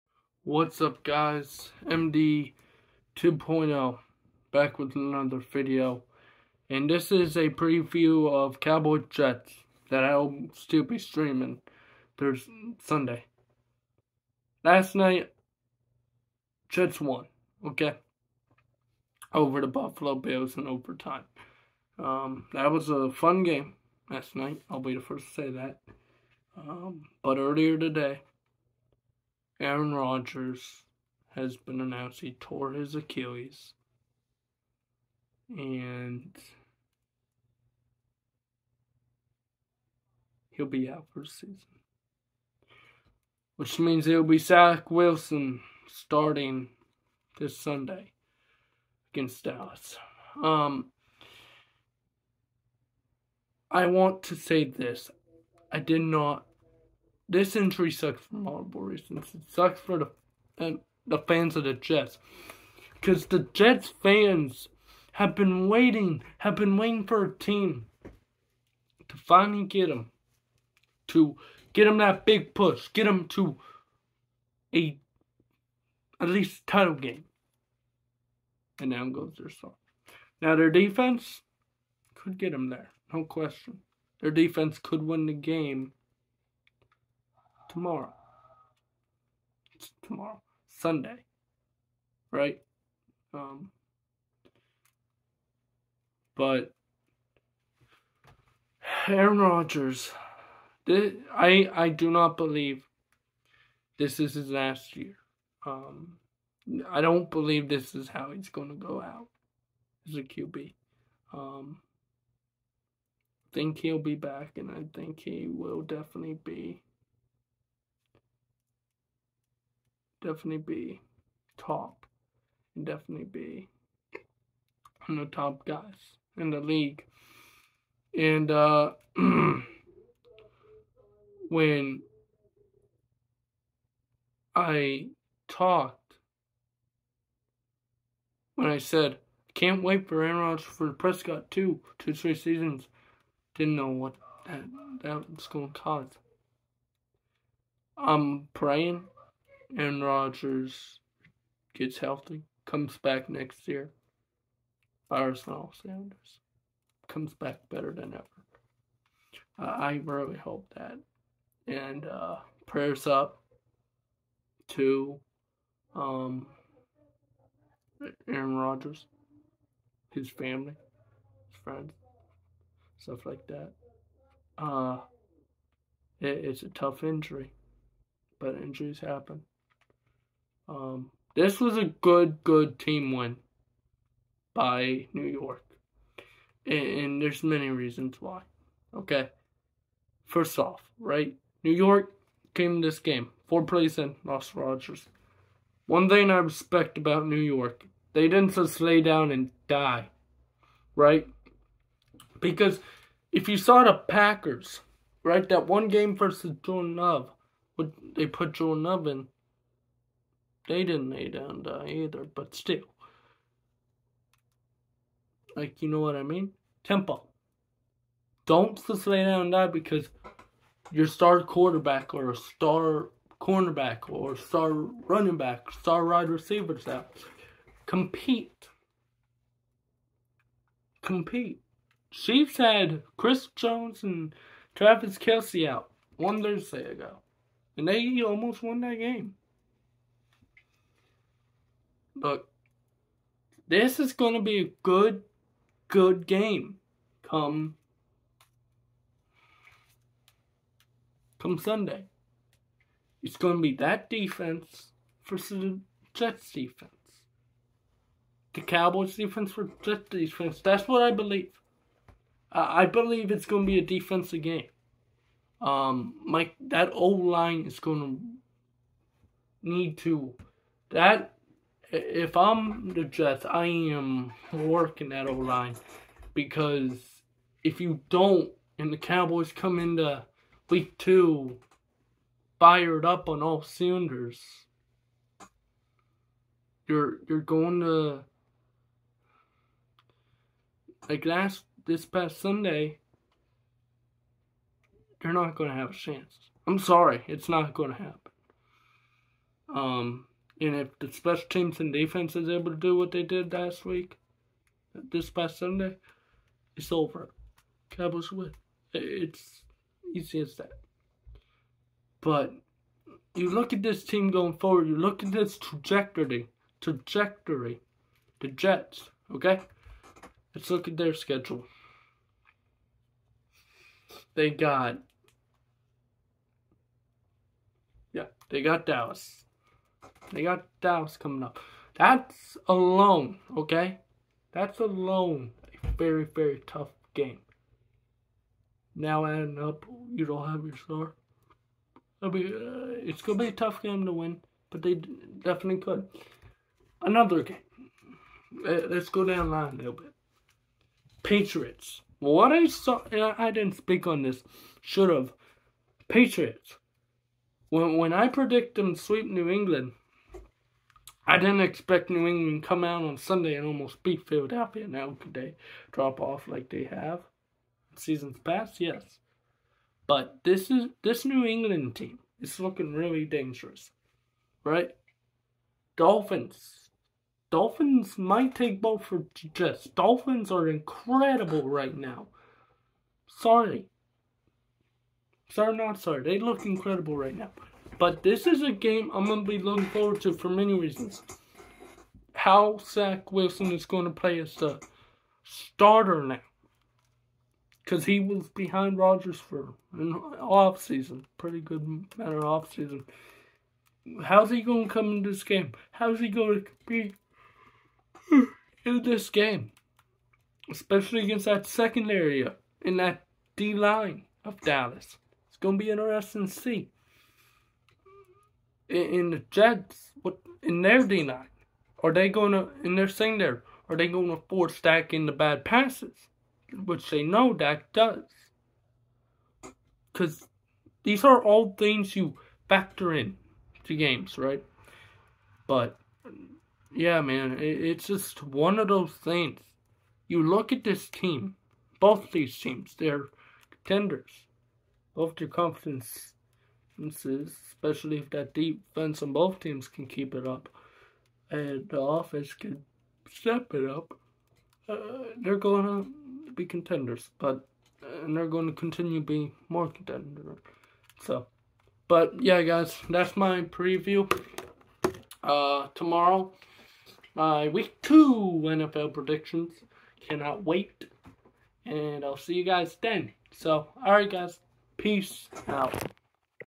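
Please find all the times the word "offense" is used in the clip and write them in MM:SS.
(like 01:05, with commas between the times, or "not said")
07:31.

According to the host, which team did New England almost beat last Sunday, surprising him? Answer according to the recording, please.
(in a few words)
Philadelphia.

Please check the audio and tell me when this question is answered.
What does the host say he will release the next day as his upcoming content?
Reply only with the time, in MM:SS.
07:47.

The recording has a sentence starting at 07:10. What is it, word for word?
Cause these are all things you factor in to games, right?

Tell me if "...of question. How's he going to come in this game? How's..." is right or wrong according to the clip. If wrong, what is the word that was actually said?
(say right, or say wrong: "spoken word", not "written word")
wrong: "offseason", not "question".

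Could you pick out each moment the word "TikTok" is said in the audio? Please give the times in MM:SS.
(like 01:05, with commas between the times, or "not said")
not said.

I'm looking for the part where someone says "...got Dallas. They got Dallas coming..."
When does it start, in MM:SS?
05:28.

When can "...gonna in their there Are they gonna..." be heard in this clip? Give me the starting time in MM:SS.
07:02.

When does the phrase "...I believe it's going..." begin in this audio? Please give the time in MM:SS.
04:22.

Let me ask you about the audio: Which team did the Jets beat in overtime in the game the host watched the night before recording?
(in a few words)
Buffalo Bills.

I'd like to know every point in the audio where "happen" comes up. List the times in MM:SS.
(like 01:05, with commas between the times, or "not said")
02:58, 04:57.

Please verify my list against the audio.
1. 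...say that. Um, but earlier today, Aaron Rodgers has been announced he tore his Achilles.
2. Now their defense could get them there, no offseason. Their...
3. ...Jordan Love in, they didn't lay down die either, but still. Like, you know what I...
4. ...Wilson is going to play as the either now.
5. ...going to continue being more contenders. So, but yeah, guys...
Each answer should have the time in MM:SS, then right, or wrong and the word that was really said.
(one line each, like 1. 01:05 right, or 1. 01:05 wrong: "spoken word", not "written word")
1. 00:25 right
2. 01:20 wrong: "question", not "offseason"
3. 03:28 right
4. 06:33 wrong: "starter", not "either"
5. 07:38 right.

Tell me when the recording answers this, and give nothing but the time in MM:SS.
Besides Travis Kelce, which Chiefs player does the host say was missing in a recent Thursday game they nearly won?
03:53.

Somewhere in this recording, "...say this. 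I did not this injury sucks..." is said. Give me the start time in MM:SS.
00:54.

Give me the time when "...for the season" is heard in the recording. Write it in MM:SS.
00:41.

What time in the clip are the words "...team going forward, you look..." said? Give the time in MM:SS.
05:14.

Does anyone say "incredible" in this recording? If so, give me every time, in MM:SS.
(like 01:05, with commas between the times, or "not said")
06:20, 06:26.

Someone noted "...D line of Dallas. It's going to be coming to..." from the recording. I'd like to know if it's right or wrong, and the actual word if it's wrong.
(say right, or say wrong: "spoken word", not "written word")
wrong: "interesting", not "coming".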